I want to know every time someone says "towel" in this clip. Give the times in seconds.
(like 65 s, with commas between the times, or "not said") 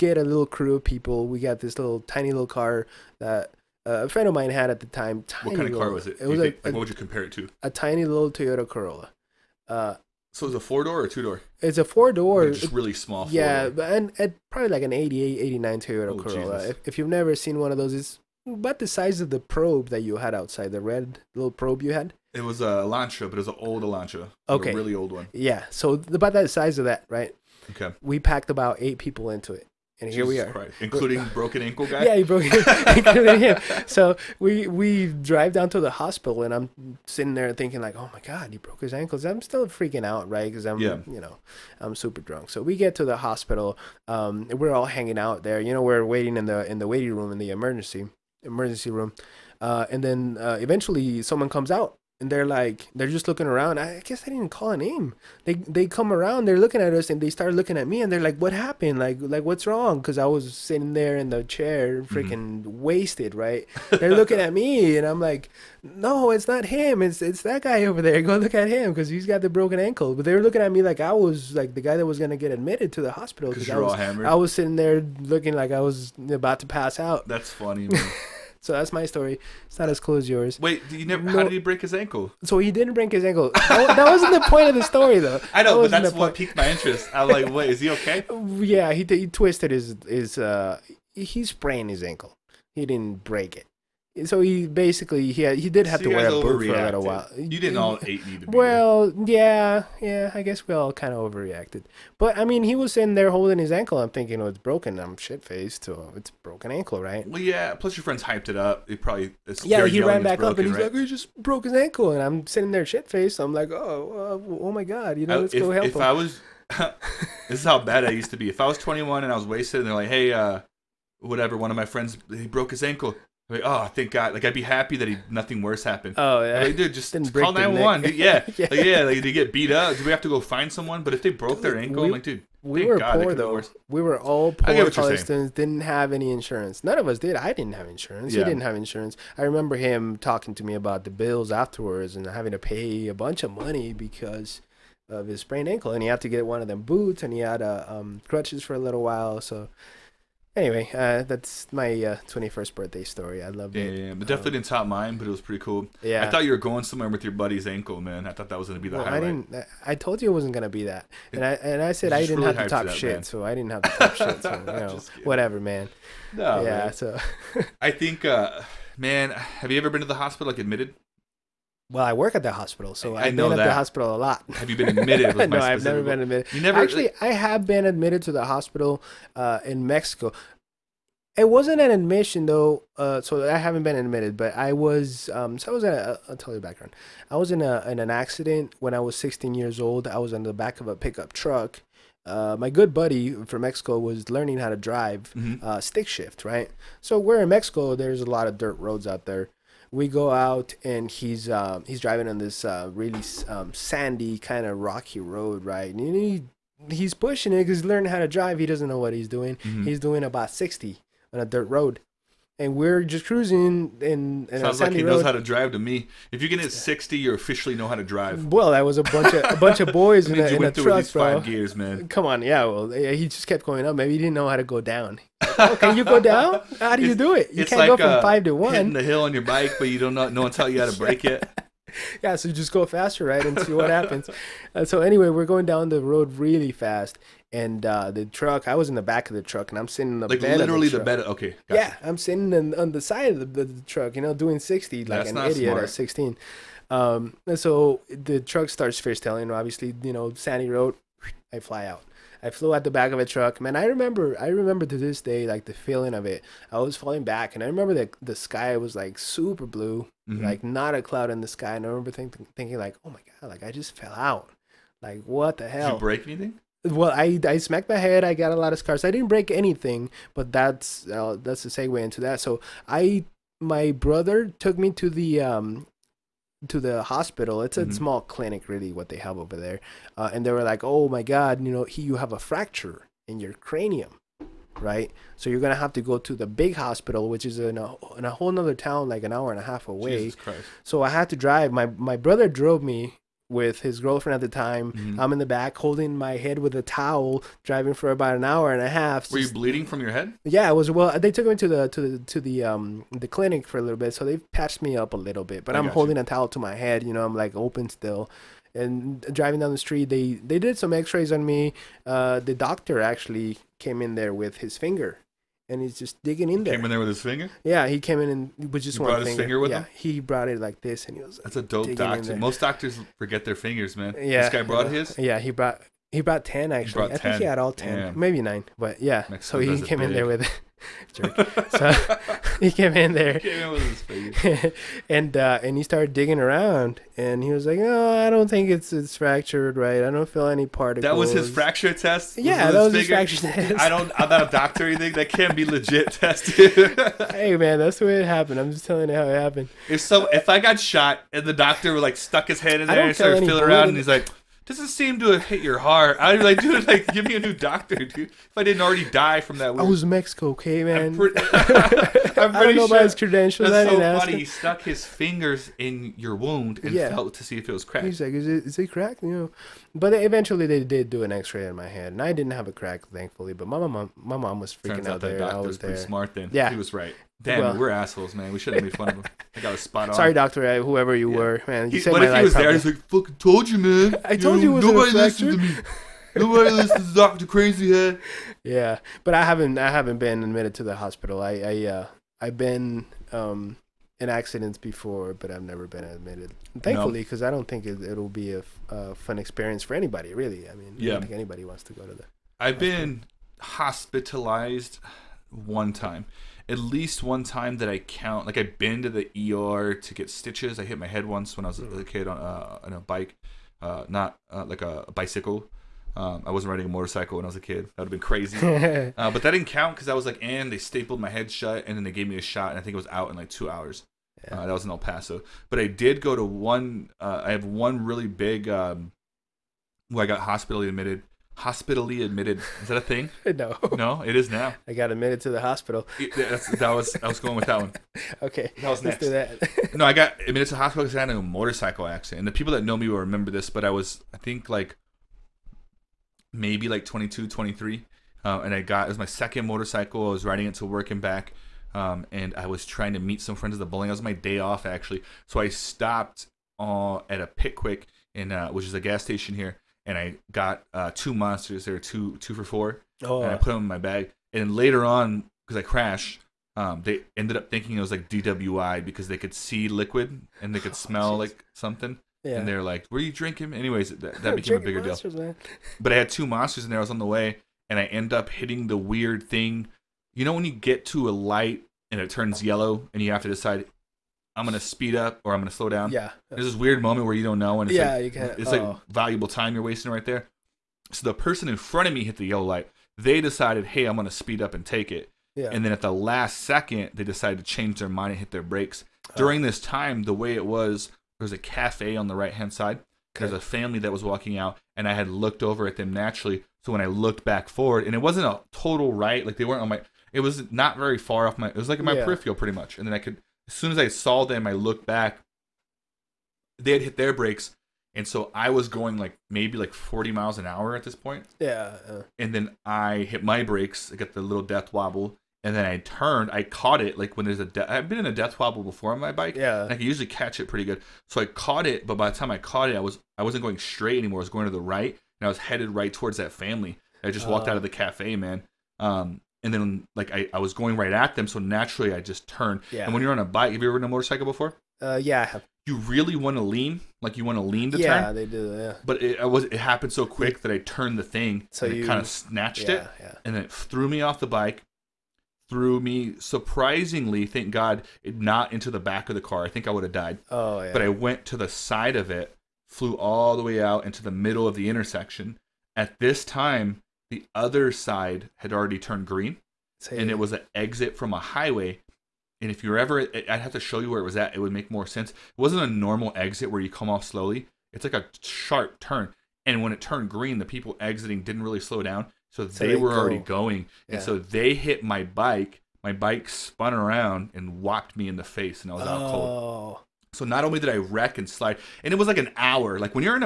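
296 s, 306 s.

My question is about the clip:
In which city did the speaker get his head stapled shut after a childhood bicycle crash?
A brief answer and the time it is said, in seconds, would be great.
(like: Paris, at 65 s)
El Paso, at 424 s.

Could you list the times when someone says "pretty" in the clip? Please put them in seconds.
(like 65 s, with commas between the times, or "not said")
155 s, 512 s, 530 s.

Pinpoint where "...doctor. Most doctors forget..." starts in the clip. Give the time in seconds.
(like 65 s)
321 s.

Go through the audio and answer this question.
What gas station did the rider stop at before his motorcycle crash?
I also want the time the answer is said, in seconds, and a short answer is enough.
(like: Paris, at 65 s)
Pic Quik, at 457 s.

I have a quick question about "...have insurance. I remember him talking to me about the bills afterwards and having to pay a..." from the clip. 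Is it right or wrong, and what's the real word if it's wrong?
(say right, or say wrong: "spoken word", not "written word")
right.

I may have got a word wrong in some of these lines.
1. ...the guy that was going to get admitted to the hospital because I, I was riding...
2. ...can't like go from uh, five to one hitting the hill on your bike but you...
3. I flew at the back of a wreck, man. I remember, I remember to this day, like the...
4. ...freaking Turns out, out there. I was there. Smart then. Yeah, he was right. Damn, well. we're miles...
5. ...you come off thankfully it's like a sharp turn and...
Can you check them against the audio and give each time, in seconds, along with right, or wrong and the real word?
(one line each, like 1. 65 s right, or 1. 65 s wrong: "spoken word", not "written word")
1. 71 s wrong: "sitting", not "riding"
2. 227 s right
3. 252 s wrong: "truck", not "wreck"
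4. 374 s wrong: "assholes", not "miles"
5. 576 s wrong: "slowly", not "thankfully".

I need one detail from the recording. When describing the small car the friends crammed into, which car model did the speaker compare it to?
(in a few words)
Toyota Corolla.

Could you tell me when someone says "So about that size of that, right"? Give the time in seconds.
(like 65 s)
25 s.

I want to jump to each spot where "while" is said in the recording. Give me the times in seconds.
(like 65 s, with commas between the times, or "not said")
97 s, 149 s.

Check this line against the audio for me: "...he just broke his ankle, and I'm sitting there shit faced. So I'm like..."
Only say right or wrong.
right.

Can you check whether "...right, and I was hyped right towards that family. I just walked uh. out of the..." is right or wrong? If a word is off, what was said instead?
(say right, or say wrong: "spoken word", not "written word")
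wrong: "headed", not "hyped".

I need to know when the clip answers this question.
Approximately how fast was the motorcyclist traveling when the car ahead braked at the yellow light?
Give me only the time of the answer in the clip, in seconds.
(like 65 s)
519 s.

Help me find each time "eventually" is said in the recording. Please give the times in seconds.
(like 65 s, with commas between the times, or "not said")
50 s, 370 s.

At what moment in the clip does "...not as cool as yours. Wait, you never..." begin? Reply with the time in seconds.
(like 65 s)
79 s.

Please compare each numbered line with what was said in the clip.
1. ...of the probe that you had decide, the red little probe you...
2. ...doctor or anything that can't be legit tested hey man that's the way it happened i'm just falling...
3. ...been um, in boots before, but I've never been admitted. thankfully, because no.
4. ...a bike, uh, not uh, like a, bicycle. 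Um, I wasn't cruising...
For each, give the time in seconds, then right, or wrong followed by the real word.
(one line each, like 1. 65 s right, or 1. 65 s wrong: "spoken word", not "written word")
1. 19 s wrong: "outside", not "decide"
2. 344 s wrong: "telling", not "falling"
3. 392 s wrong: "accidents", not "boots"
4. 412 s wrong: "riding", not "cruising".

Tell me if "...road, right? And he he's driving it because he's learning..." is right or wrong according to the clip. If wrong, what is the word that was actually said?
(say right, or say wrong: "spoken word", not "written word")
wrong: "pushing", not "driving".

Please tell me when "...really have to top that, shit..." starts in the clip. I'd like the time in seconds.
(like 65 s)
162 s.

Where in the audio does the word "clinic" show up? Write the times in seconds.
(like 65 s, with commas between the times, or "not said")
278 s, 303 s.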